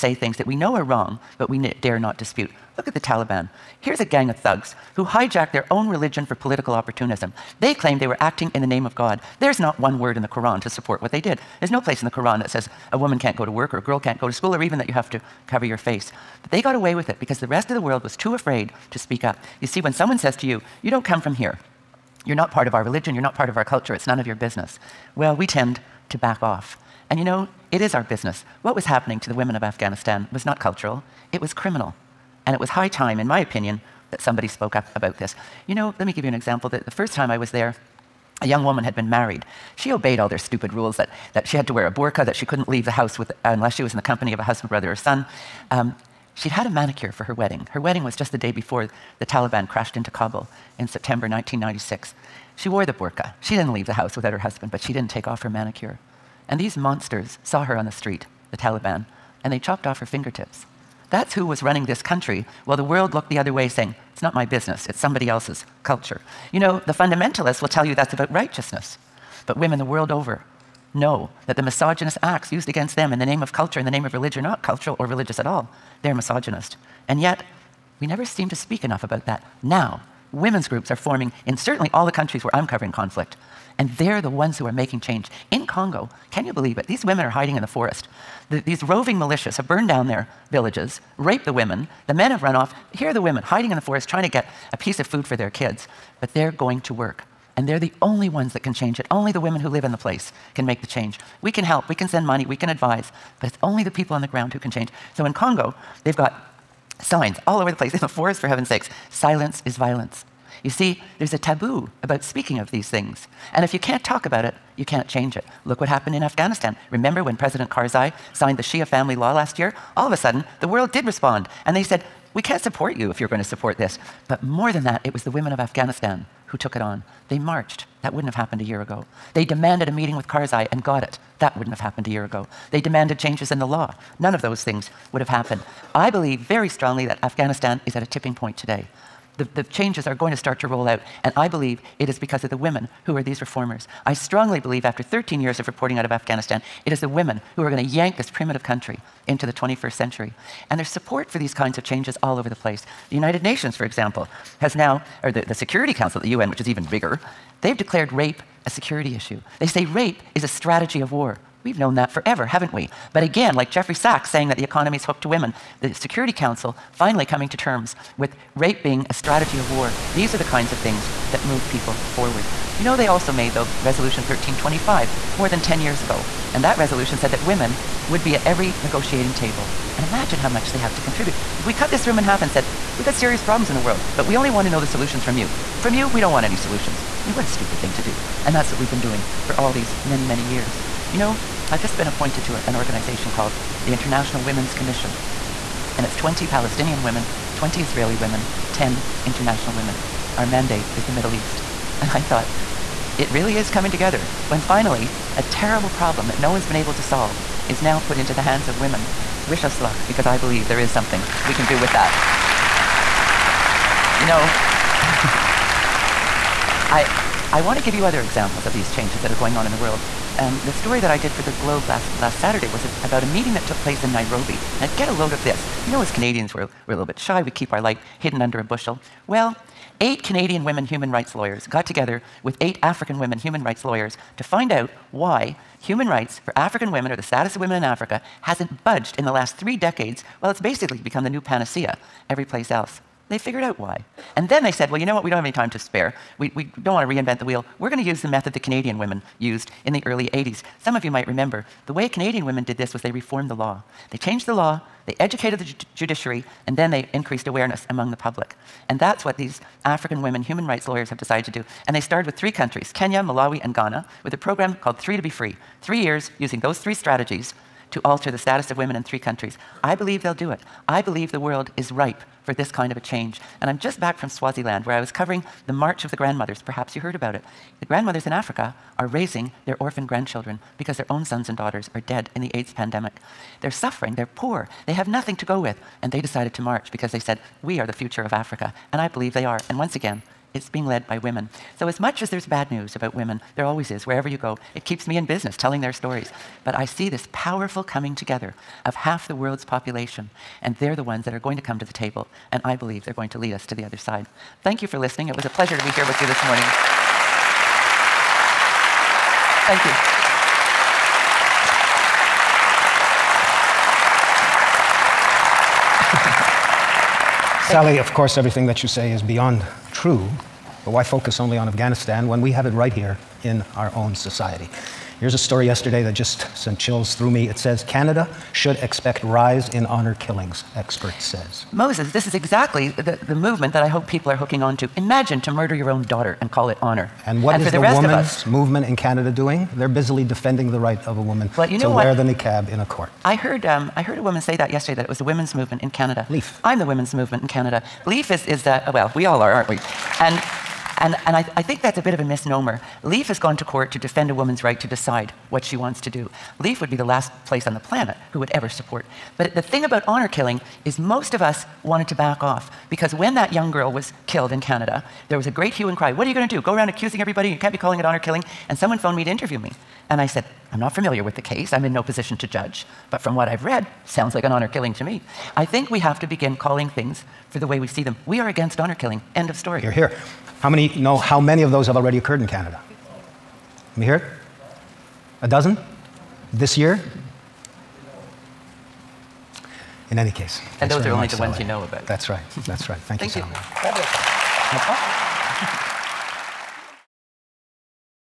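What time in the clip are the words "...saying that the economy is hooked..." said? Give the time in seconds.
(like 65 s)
164 s.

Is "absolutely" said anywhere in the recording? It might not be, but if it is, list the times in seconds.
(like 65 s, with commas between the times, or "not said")
not said.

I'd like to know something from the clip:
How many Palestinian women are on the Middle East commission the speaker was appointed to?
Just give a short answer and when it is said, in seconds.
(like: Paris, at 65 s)
20, at 196 s.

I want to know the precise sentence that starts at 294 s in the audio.
It keeps me in business telling their stories.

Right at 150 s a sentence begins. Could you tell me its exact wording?
And there's support for these kinds of changes all over the place.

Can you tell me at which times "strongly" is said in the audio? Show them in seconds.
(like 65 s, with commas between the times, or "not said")
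136 s, 144 s.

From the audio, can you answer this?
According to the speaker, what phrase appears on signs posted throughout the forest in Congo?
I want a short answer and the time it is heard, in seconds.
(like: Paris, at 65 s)
Silence is violence, at 109 s.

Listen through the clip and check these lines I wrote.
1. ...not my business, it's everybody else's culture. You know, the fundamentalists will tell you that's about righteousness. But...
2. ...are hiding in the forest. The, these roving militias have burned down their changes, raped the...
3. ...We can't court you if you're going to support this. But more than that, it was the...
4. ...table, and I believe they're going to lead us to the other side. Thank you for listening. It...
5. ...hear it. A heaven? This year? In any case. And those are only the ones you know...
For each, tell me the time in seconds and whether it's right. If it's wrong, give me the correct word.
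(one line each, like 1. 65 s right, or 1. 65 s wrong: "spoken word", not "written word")
1. 64 s wrong: "somebody", not "everybody"
2. 87 s wrong: "villages", not "changes"
3. 122 s wrong: "support", not "court"
4. 301 s right
5. 384 s wrong: "dozen", not "heaven".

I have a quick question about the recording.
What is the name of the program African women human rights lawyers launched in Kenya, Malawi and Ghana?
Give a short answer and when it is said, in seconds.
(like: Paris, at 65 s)
Three to Be Free, at 264 s.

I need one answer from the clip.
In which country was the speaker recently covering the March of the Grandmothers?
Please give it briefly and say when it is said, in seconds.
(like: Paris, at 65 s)
Swaziland, at 274 s.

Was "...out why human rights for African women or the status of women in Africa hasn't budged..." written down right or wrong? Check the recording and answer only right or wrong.
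right.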